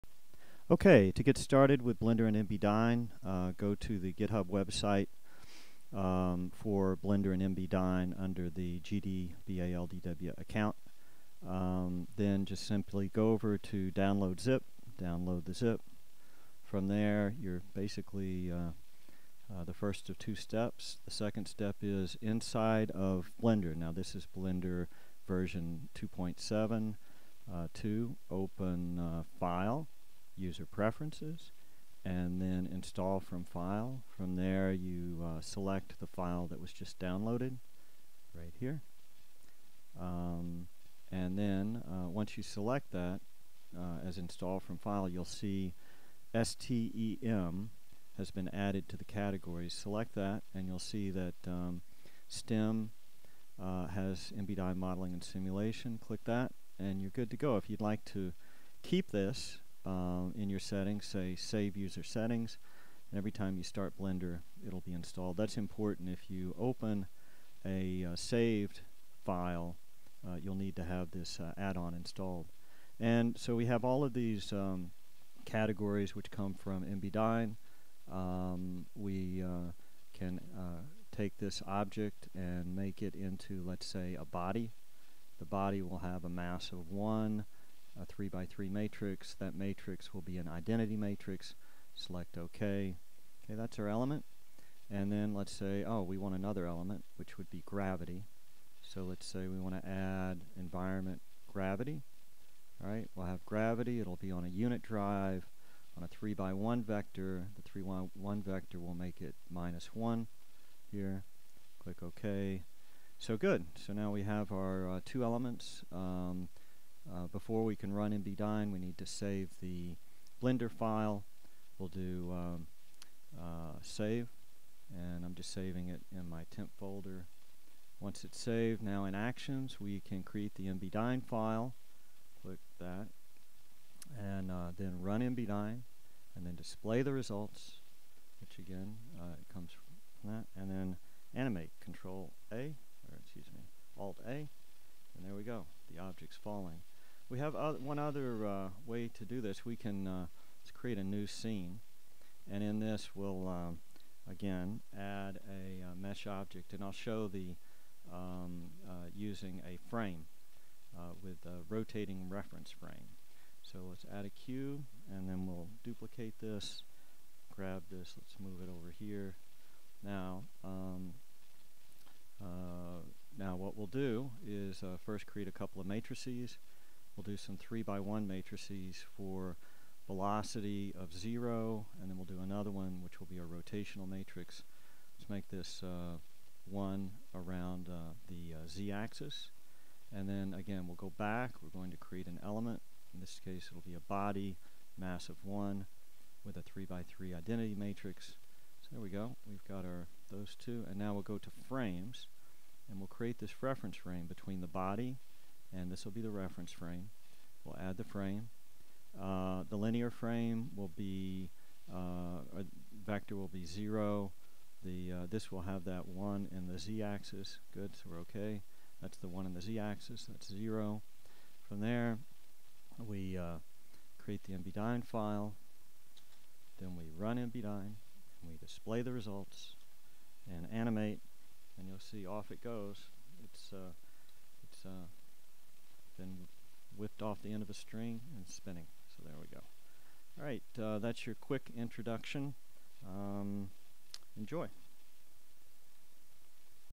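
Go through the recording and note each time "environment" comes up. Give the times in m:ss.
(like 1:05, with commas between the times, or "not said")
1:40.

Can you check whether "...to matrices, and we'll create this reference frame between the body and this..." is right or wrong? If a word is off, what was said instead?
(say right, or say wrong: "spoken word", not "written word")
wrong: "frames", not "matrices".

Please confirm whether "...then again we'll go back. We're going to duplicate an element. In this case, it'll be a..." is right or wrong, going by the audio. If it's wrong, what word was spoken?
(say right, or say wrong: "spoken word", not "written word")
wrong: "create", not "duplicate".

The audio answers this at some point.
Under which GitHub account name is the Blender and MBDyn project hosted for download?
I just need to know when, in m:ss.
0:08.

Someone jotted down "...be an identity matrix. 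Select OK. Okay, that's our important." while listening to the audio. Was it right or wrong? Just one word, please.
wrong.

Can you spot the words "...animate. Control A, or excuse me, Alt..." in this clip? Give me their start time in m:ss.
2:21.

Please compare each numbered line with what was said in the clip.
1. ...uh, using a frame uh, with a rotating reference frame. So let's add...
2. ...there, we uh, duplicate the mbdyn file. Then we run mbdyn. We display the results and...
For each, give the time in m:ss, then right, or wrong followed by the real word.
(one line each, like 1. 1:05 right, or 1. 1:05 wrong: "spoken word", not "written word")
1. 2:38 right
2. 3:41 wrong: "create", not "duplicate".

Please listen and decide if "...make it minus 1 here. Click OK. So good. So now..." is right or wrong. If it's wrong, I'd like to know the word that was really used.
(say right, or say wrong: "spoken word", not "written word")
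right.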